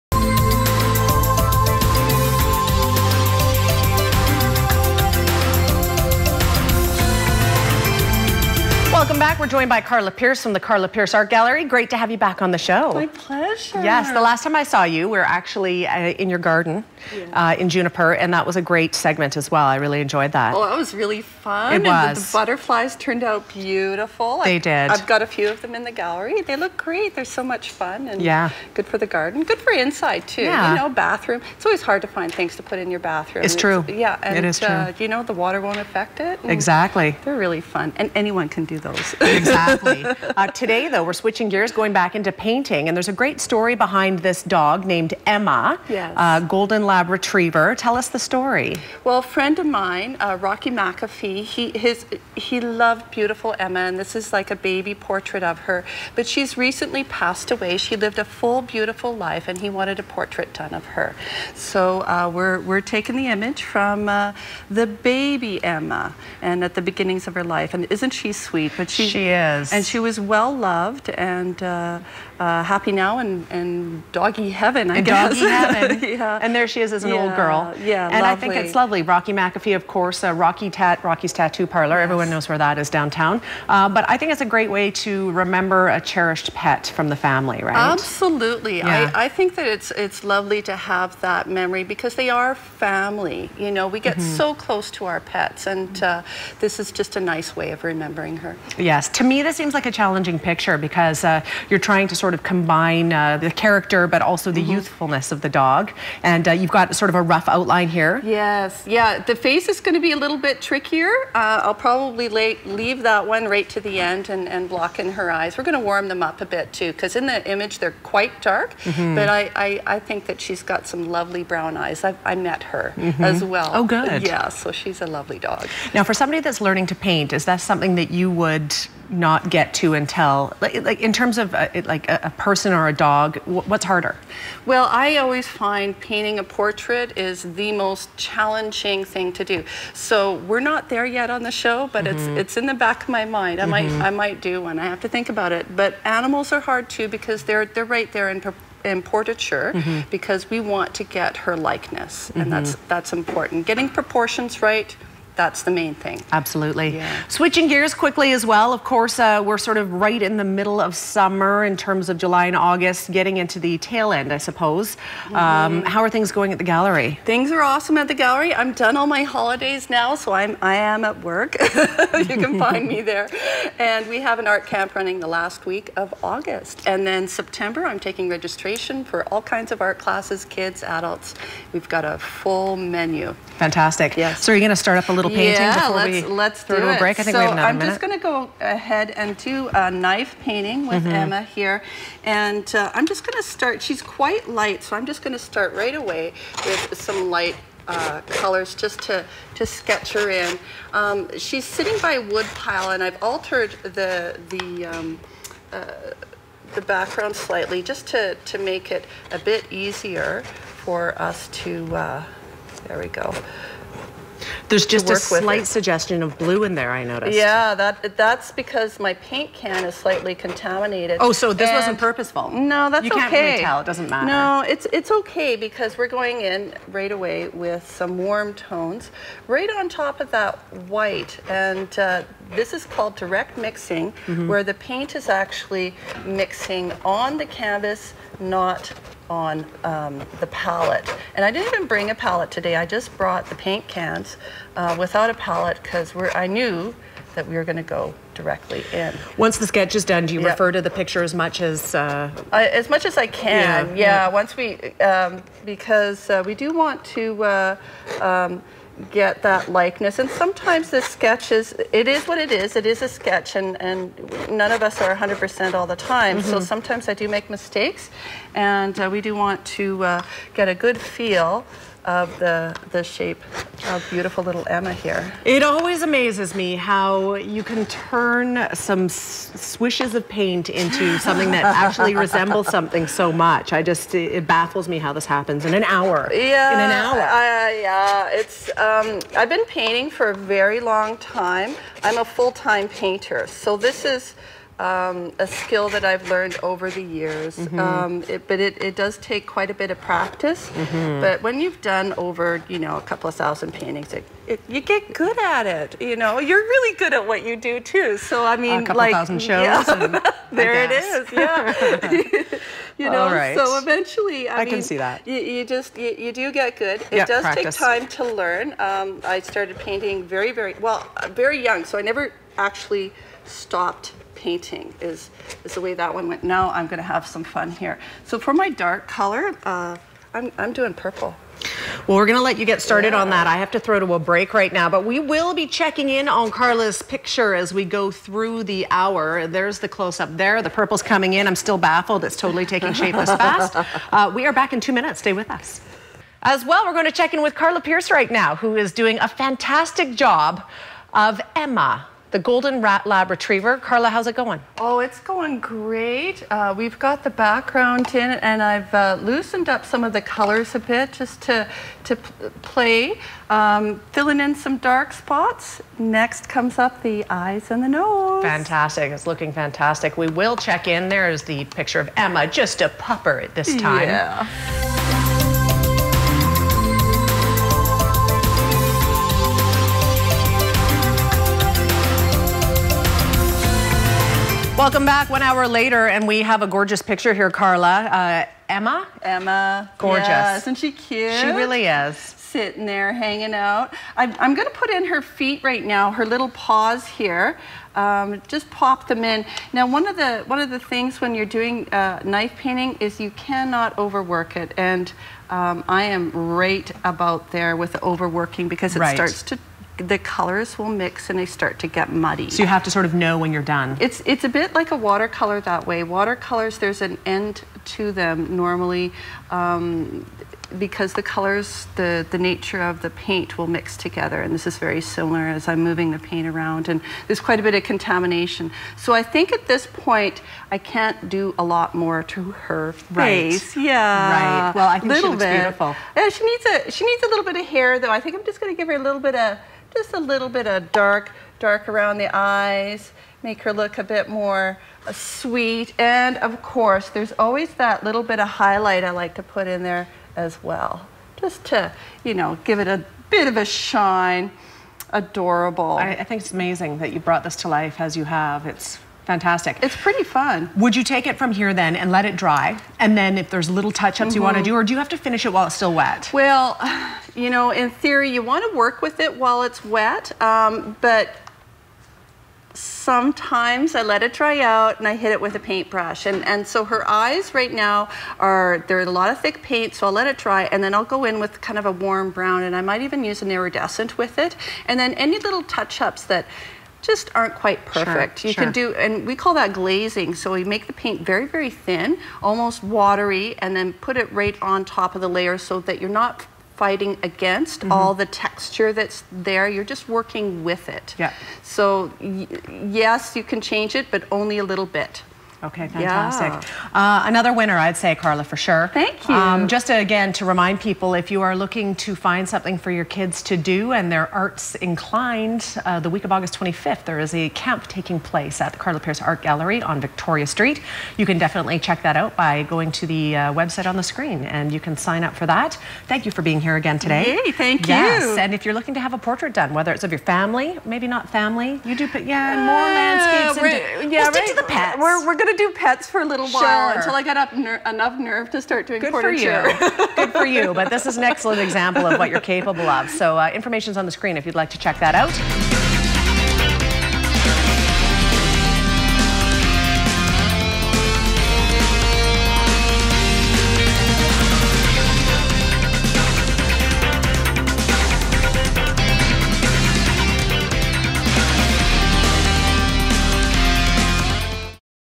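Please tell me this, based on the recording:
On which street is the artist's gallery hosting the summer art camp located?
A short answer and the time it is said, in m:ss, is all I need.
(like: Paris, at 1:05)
Victoria Street, at 8:40.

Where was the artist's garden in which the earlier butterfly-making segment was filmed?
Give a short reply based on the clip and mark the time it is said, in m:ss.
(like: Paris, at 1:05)
Juniper, at 0:17.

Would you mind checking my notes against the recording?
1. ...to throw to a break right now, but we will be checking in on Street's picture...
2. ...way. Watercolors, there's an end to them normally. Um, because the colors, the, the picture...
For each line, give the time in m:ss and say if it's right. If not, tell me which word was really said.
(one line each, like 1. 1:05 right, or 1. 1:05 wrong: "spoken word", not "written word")
1. 5:33 wrong: "Karla", not "Street"
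2. 6:55 wrong: "nature", not "picture".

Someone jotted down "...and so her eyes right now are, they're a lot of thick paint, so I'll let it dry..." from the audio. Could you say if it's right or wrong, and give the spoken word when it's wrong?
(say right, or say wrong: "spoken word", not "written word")
right.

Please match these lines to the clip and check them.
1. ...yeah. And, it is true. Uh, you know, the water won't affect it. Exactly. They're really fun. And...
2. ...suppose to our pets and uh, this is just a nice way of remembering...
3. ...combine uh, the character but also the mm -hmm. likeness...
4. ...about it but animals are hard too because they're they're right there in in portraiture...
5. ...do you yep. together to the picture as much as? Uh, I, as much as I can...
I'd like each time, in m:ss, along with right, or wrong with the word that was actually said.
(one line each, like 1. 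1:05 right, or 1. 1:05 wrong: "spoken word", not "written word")
1. 0:33 right
2. 1:34 wrong: "close", not "suppose"
3. 1:42 wrong: "youthfulness", not "likeness"
4. 2:25 right
5. 4:10 wrong: "refer", not "together".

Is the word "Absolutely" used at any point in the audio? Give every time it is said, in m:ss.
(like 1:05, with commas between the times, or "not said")
1:27, 2:36.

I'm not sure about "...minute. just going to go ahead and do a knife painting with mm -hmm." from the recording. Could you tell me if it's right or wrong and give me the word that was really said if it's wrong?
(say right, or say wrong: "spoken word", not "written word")
right.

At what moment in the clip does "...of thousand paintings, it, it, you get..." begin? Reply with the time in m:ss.
5:03.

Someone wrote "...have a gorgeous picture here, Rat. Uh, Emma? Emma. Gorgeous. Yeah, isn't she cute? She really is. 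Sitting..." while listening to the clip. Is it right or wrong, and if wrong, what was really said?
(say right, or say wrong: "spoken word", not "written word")
wrong: "Karla", not "Rat".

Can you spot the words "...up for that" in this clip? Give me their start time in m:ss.
8:45.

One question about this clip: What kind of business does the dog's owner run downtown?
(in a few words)
Tattoo Parlor.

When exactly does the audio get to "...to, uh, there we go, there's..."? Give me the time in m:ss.
3:31.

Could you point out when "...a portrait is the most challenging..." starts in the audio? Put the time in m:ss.
2:16.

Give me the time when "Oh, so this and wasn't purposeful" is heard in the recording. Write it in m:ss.
3:41.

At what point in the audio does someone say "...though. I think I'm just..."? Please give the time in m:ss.
7:17.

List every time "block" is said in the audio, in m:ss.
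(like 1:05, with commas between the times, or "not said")
1:54.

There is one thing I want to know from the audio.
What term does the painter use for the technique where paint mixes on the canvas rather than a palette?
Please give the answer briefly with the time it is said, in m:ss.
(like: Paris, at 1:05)
direct mixing, at 3:53.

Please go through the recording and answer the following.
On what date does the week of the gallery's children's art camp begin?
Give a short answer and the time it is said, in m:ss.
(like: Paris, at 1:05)
August 25th, at 8:36.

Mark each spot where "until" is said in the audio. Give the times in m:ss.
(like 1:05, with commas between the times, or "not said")
2:09, 8:56.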